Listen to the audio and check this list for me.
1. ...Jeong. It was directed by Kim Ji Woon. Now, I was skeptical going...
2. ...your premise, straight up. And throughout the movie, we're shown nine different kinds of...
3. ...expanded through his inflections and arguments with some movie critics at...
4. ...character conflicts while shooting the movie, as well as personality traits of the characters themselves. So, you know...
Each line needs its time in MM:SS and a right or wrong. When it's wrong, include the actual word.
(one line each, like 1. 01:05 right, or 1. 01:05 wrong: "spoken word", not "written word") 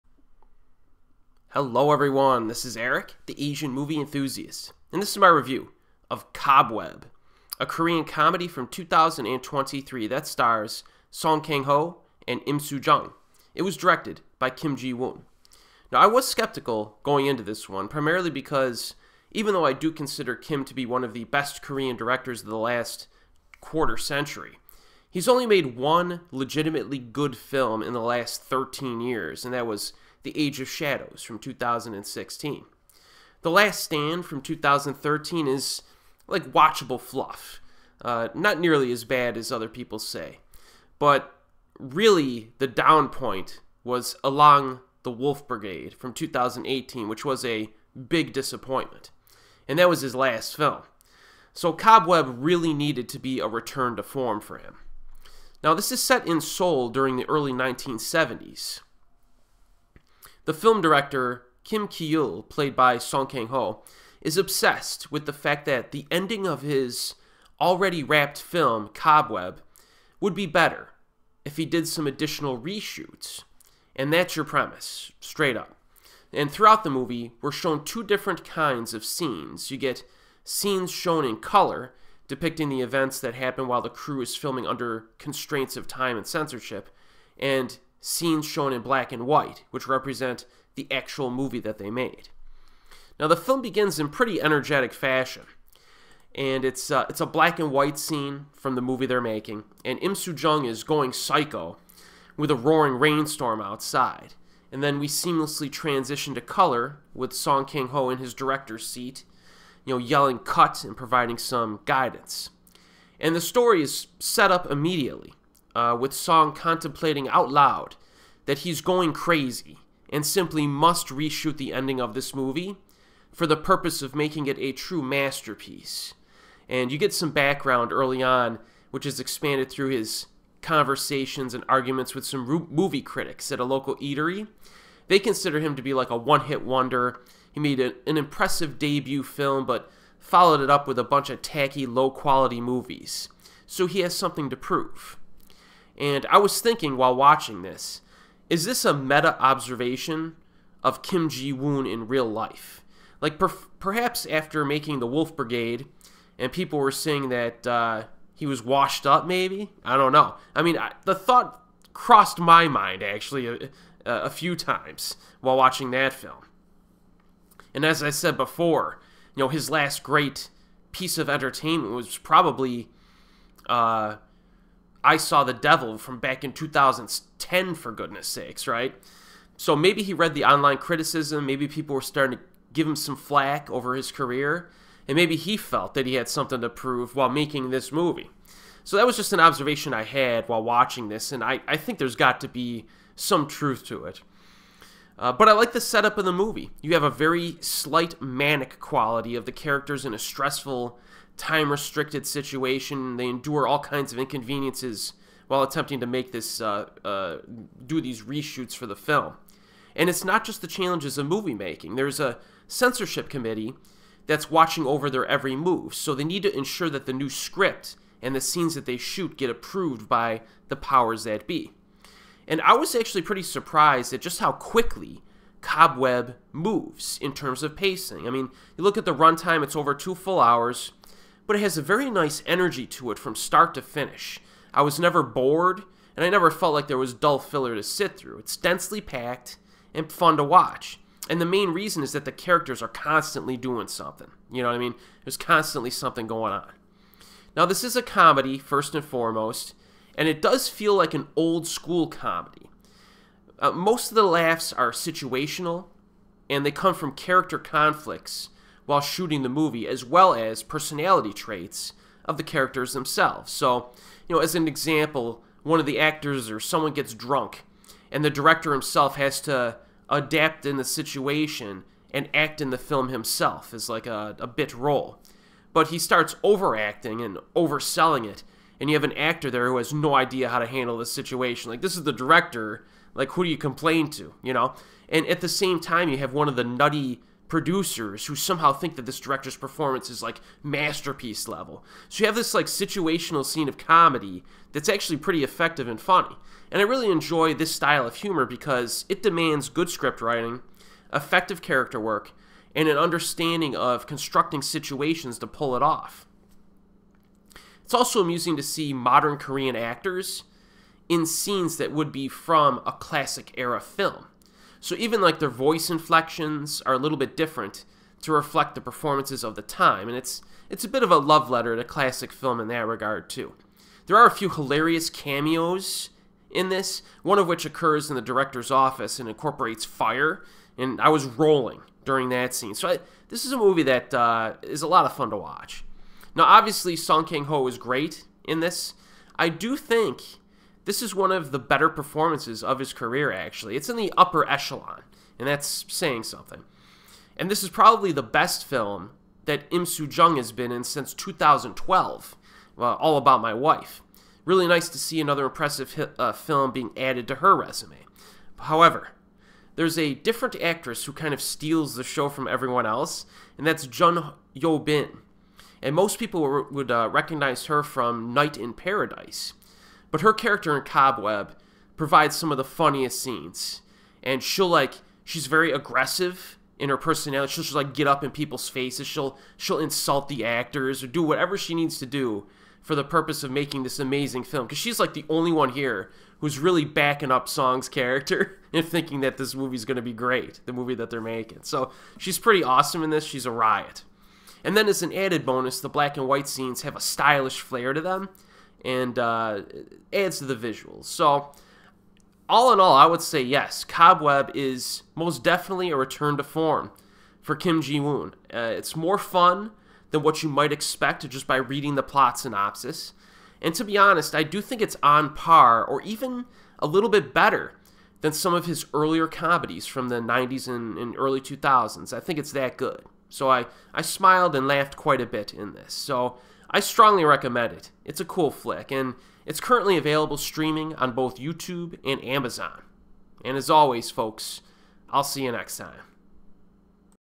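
1. 00:12 right
2. 01:14 wrong: "two", not "nine"
3. 02:09 wrong: "conversations", not "inflections"
4. 04:17 right.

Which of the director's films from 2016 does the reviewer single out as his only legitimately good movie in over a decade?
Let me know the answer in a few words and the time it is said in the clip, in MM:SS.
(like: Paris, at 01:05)
The Age of Shadows, at 00:30.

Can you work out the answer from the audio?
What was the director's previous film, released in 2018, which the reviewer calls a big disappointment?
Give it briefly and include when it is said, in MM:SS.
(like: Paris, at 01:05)
Illang the Wolf Brigade, at 00:44.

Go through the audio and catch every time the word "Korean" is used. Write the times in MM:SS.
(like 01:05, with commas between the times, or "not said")
00:07, 00:21, 05:09.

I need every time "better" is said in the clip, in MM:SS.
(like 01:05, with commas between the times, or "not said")
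01:10, 05:41, 06:57.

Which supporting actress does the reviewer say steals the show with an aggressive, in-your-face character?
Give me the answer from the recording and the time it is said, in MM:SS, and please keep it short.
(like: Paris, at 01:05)
Jeon Yo Bin, at 06:03.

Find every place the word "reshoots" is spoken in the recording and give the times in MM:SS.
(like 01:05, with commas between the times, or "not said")
01:12, 02:01, 03:28.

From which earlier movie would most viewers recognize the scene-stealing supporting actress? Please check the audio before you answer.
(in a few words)
Night in Paradise.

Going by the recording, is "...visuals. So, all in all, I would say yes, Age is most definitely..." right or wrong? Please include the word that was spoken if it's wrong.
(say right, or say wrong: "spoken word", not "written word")
wrong: "Cobweb", not "Age".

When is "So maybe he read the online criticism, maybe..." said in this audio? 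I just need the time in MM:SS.
02:59.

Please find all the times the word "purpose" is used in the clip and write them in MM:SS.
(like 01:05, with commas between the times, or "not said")
02:03, 06:23.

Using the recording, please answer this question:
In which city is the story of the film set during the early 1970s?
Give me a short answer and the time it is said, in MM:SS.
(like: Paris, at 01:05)
Seoul, at 00:56.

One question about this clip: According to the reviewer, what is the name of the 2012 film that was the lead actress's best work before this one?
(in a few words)
All About My Wife.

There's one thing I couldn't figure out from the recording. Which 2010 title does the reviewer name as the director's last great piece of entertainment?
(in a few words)
I Saw the Devil.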